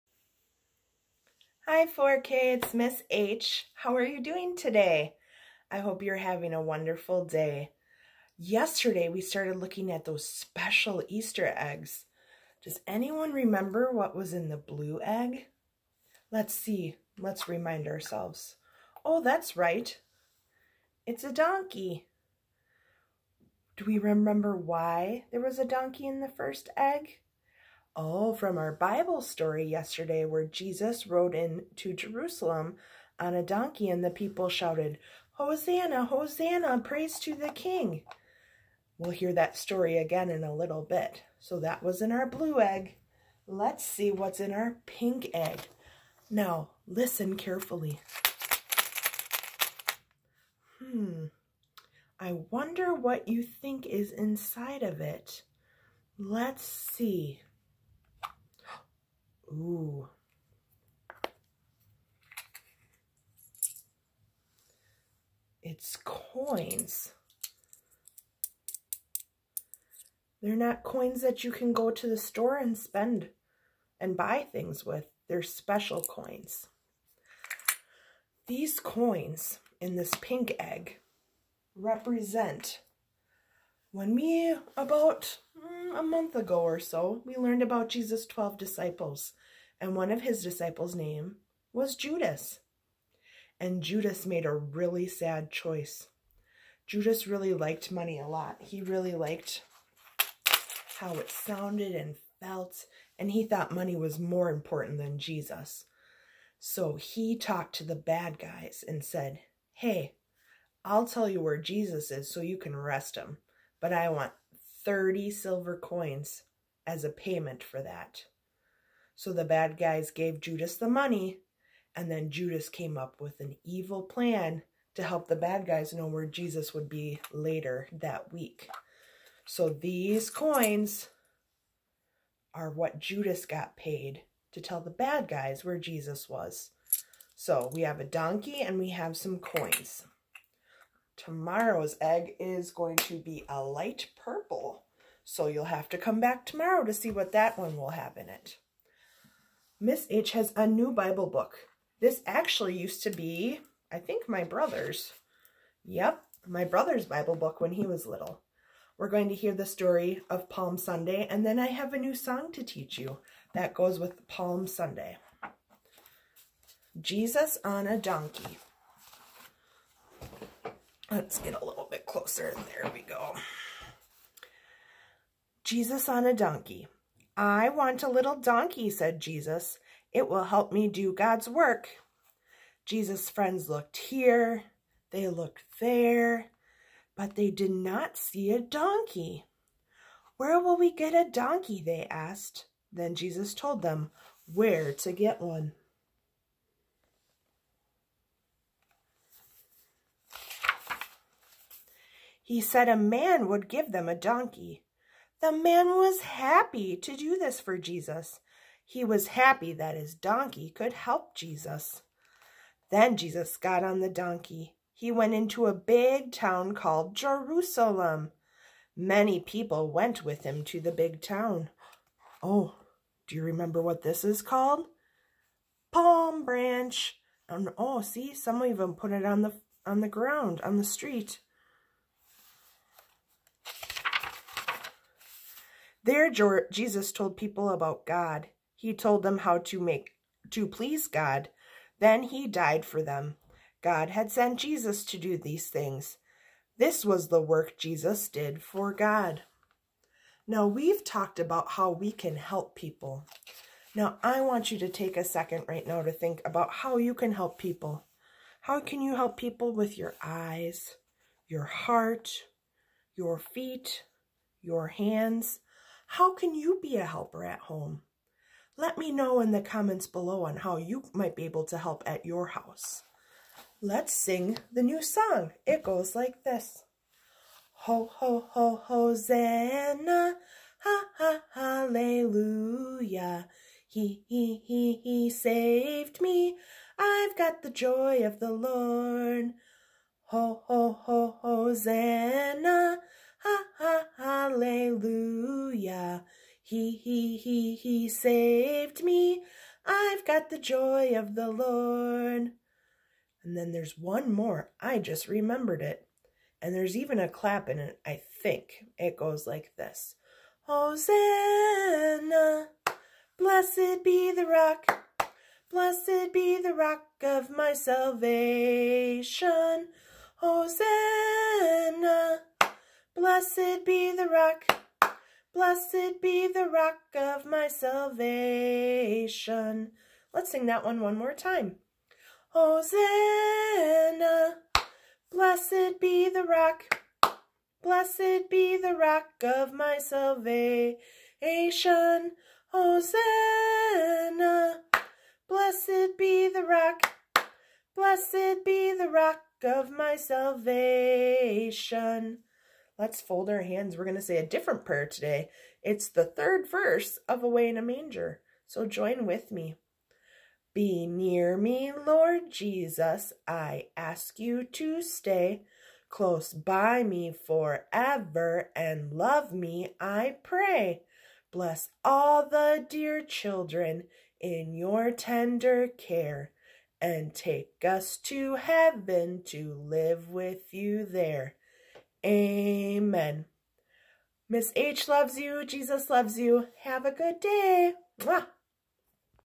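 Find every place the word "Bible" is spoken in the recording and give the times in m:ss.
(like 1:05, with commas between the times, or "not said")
0:28, 2:30, 2:37.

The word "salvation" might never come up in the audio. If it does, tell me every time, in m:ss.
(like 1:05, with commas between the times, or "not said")
5:17, 5:27, 5:39, 5:50.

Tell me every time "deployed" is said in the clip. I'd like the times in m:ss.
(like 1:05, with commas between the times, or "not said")
not said.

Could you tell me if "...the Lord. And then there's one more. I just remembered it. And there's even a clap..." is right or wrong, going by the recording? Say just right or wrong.
right.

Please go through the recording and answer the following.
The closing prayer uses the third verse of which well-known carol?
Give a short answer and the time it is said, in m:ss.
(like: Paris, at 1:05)
Away in a Manger, at 5:57.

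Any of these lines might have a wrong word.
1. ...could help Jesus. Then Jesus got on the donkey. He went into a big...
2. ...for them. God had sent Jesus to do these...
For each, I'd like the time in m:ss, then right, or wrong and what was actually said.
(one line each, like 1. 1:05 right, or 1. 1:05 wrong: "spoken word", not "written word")
1. 3:30 right
2. 4:02 right.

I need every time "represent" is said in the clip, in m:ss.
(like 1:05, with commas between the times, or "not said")
1:21.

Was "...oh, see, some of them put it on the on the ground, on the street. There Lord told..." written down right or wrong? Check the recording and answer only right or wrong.
wrong.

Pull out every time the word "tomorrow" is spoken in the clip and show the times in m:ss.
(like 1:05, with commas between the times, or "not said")
2:21, 2:26.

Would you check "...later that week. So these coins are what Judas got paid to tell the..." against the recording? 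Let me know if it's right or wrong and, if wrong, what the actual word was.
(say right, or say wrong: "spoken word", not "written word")
right.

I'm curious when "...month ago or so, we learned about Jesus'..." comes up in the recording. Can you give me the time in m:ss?
1:26.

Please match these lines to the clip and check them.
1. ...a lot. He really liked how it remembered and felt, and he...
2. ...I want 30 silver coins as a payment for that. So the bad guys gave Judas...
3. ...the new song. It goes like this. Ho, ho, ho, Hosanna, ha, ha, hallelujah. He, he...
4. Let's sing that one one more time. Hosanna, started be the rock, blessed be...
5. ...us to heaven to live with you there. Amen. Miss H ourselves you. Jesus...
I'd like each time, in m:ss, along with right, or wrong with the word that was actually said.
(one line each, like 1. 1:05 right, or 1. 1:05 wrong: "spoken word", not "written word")
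1. 1:38 wrong: "sounded", not "remembered"
2. 1:53 right
3. 4:34 right
4. 5:30 wrong: "blessed", not "started"
5. 6:17 wrong: "loves", not "ourselves".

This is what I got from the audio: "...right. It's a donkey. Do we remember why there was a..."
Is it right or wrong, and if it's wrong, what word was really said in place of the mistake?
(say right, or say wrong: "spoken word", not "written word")
right.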